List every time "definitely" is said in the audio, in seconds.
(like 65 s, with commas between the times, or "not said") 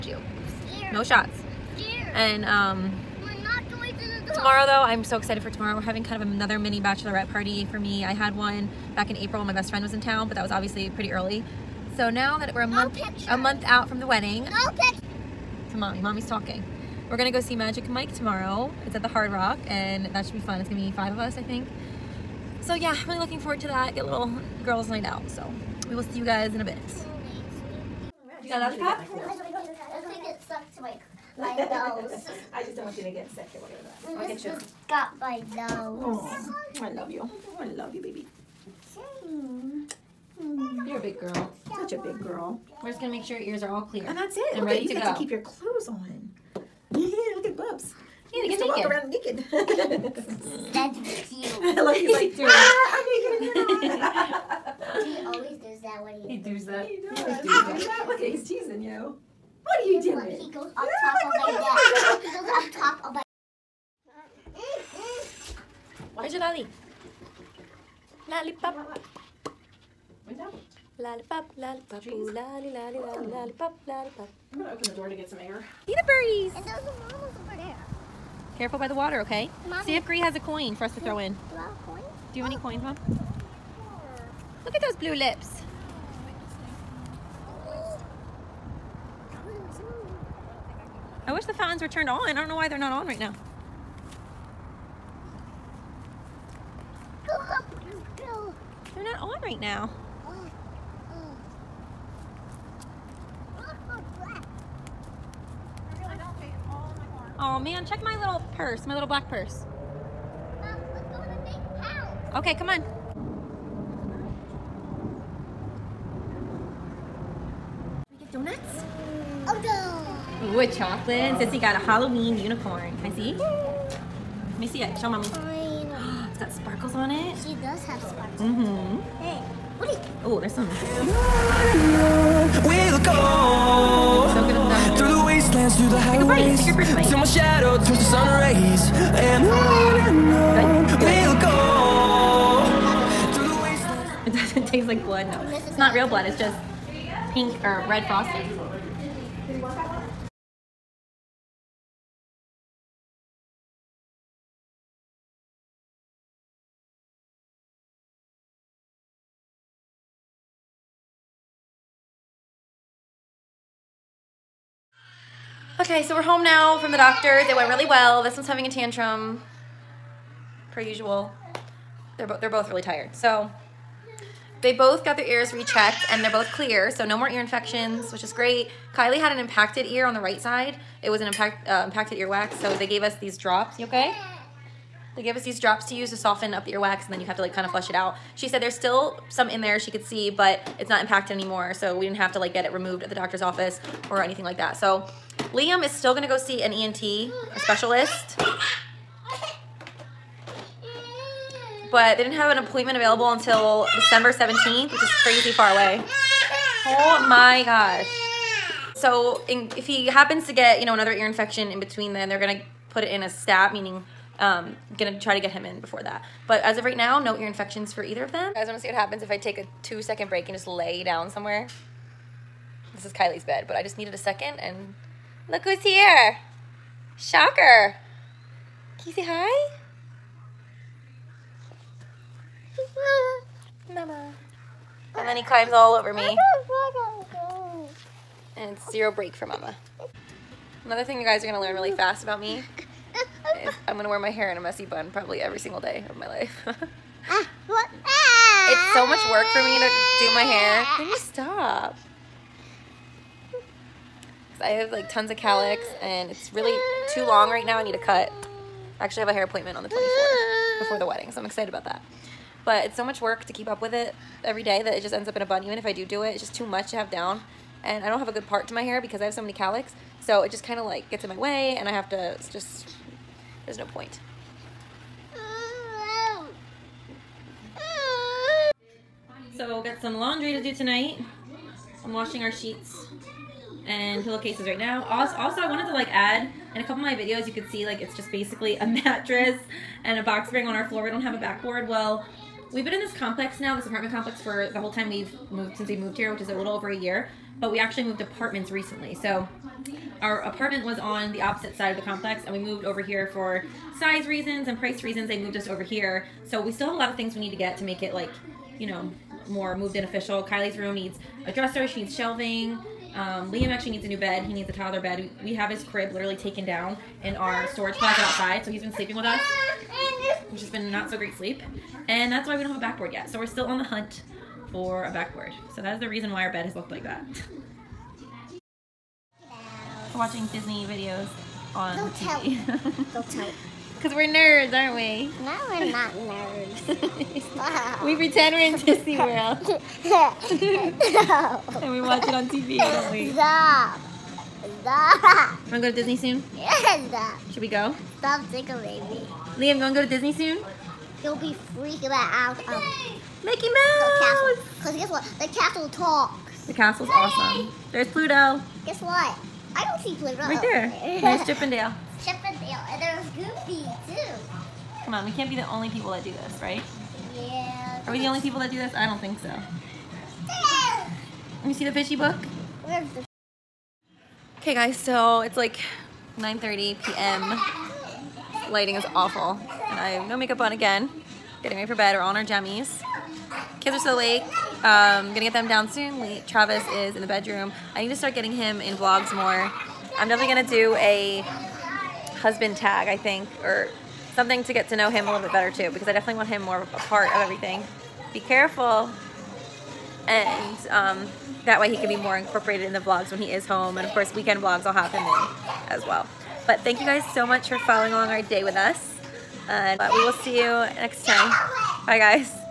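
390 s, 396 s.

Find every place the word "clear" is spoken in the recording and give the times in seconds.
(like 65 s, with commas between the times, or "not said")
43 s, 176 s.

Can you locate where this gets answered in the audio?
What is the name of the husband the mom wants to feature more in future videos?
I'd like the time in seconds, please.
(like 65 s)
386 s.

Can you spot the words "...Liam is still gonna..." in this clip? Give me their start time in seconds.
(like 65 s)
195 s.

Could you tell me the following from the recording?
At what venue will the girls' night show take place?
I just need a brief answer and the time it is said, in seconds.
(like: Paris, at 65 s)
Hard Rock, at 19 s.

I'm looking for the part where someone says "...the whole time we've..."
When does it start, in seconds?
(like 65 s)
294 s.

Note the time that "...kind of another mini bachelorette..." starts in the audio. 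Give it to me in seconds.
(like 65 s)
6 s.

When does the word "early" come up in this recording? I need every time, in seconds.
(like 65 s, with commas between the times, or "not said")
11 s.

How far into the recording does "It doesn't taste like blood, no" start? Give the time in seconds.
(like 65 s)
144 s.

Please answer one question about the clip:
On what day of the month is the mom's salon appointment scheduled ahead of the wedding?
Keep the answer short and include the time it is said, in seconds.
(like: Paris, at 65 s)
24th, at 259 s.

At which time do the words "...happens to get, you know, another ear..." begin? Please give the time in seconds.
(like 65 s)
210 s.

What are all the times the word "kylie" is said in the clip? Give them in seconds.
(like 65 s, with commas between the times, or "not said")
178 s, 223 s, 310 s.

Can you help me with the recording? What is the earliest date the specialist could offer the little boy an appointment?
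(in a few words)
December 17th.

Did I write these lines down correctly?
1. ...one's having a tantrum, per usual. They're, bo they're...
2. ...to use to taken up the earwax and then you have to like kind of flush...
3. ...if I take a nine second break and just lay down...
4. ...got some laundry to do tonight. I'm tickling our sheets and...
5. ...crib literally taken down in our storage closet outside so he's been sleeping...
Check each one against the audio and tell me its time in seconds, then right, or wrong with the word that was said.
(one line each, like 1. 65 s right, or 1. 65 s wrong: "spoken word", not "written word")
1. 168 s right
2. 185 s wrong: "soften", not "taken"
3. 219 s wrong: "two", not "nine"
4. 279 s wrong: "washing", not "tickling"
5. 315 s right.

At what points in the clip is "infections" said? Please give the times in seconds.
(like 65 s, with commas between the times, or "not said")
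177 s, 211 s, 217 s.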